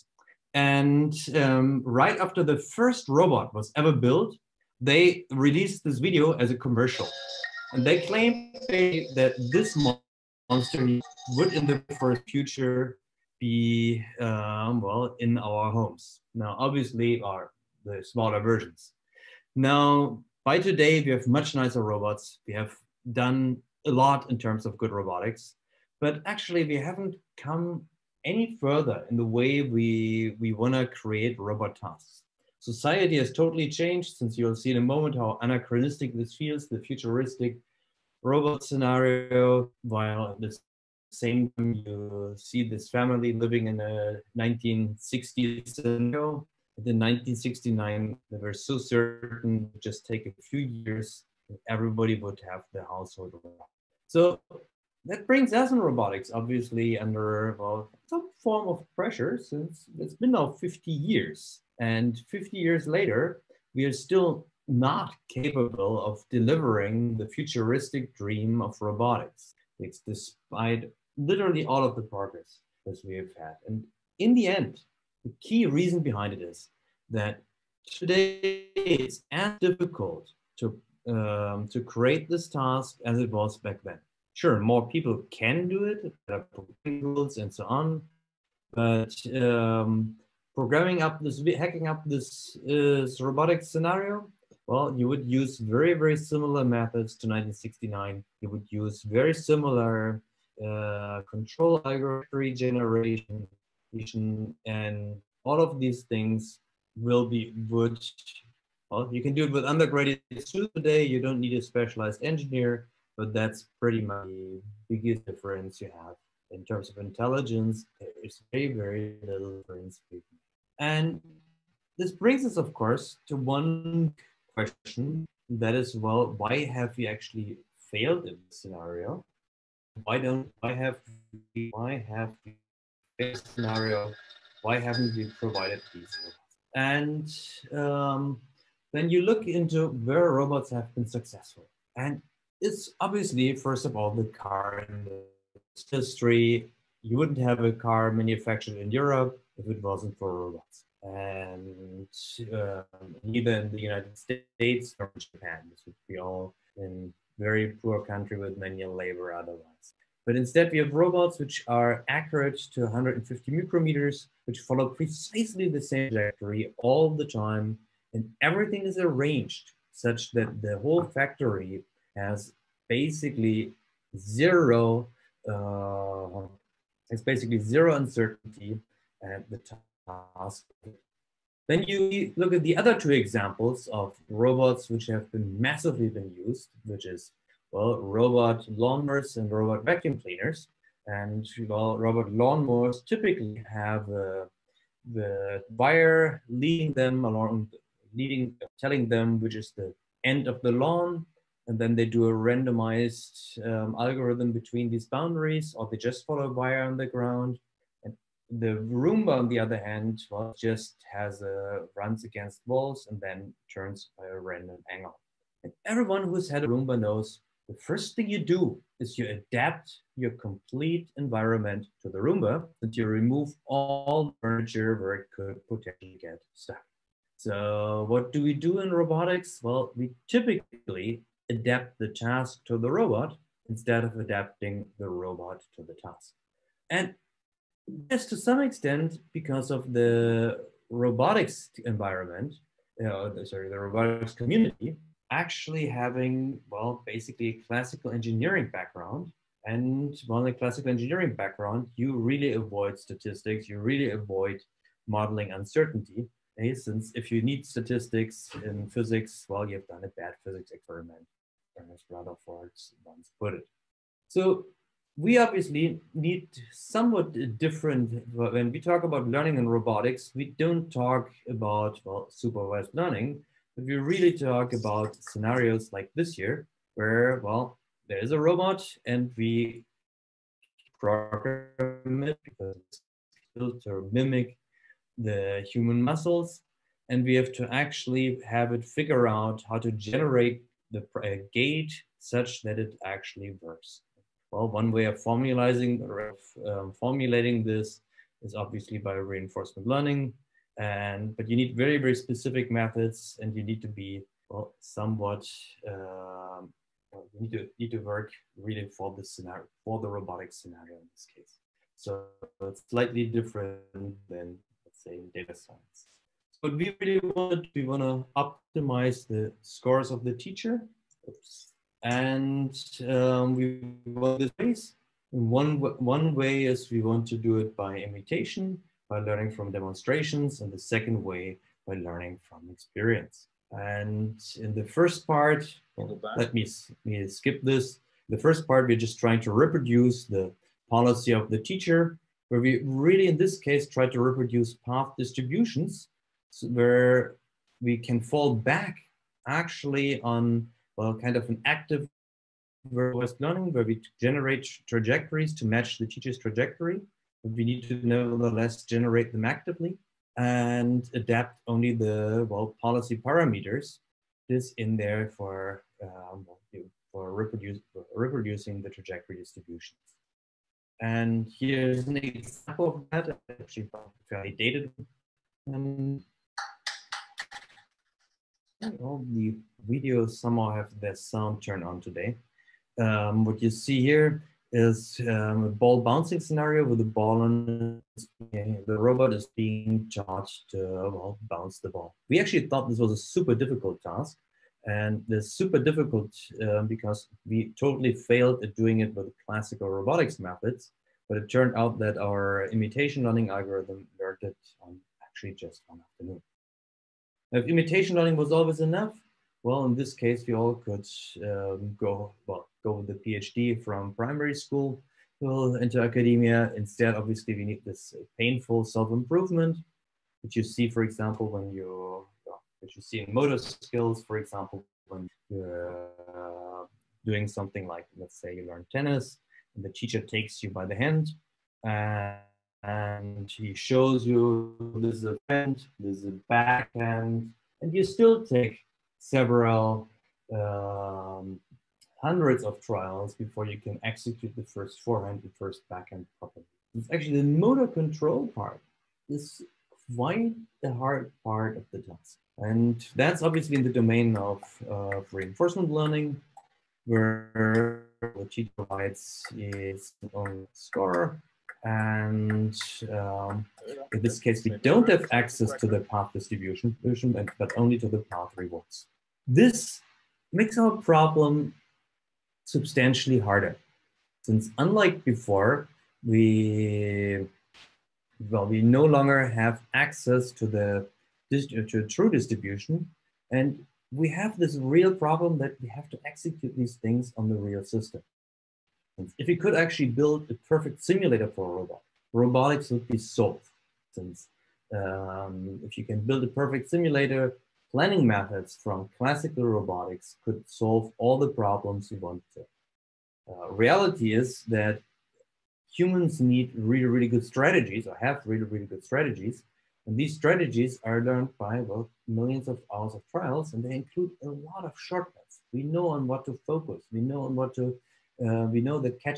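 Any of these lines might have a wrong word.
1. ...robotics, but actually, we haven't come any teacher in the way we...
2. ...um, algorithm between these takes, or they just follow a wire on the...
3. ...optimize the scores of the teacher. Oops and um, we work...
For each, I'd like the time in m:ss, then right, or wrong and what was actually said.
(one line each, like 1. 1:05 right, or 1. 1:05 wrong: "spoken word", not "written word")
1. 0:24 wrong: "further", not "teacher"
2. 3:23 wrong: "boundaries", not "takes"
3. 5:18 right.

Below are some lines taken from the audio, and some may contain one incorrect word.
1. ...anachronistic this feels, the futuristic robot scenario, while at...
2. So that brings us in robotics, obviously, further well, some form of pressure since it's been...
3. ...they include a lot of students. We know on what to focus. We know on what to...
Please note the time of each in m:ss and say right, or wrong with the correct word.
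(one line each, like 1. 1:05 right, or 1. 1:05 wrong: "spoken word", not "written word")
1. 0:35 right
2. 0:54 wrong: "under", not "further"
3. 8:33 wrong: "shortcuts", not "students".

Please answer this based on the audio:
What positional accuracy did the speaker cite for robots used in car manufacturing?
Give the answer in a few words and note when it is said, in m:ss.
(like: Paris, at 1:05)
150 micrometers, at 2:42.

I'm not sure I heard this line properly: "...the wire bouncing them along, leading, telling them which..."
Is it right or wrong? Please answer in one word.
wrong.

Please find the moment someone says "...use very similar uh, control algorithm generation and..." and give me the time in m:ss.
1:38.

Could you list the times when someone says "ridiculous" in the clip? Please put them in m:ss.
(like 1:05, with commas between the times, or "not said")
not said.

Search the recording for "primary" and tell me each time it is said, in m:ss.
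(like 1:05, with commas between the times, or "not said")
6:54.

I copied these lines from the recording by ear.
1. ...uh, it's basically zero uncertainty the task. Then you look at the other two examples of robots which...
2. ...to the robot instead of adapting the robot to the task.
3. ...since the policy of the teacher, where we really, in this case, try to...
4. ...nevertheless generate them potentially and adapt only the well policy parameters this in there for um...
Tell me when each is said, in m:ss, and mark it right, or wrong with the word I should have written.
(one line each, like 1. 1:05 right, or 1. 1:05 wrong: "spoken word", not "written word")
1. 2:55 right
2. 3:52 right
3. 5:39 wrong: "reproduce", not "since"
4. 5:58 wrong: "actively", not "potentially".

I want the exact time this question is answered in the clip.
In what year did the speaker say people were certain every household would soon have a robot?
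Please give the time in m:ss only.
0:46.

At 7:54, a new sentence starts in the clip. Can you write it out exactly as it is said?
Since unlike before, we, well, we no longer have access to the to true distribution.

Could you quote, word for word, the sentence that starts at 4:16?
Hey, eh, Since if you need statistics in physics, well, you've done a bad physics experiment, as Rutherford once put it.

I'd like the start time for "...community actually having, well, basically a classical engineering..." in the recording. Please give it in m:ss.
4:04.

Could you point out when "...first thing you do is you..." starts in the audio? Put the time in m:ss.
3:37.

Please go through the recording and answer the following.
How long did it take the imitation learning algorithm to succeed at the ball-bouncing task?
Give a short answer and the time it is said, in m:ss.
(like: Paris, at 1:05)
one afternoon, at 6:45.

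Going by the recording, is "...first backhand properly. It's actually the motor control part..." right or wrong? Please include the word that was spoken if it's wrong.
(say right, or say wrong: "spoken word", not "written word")
right.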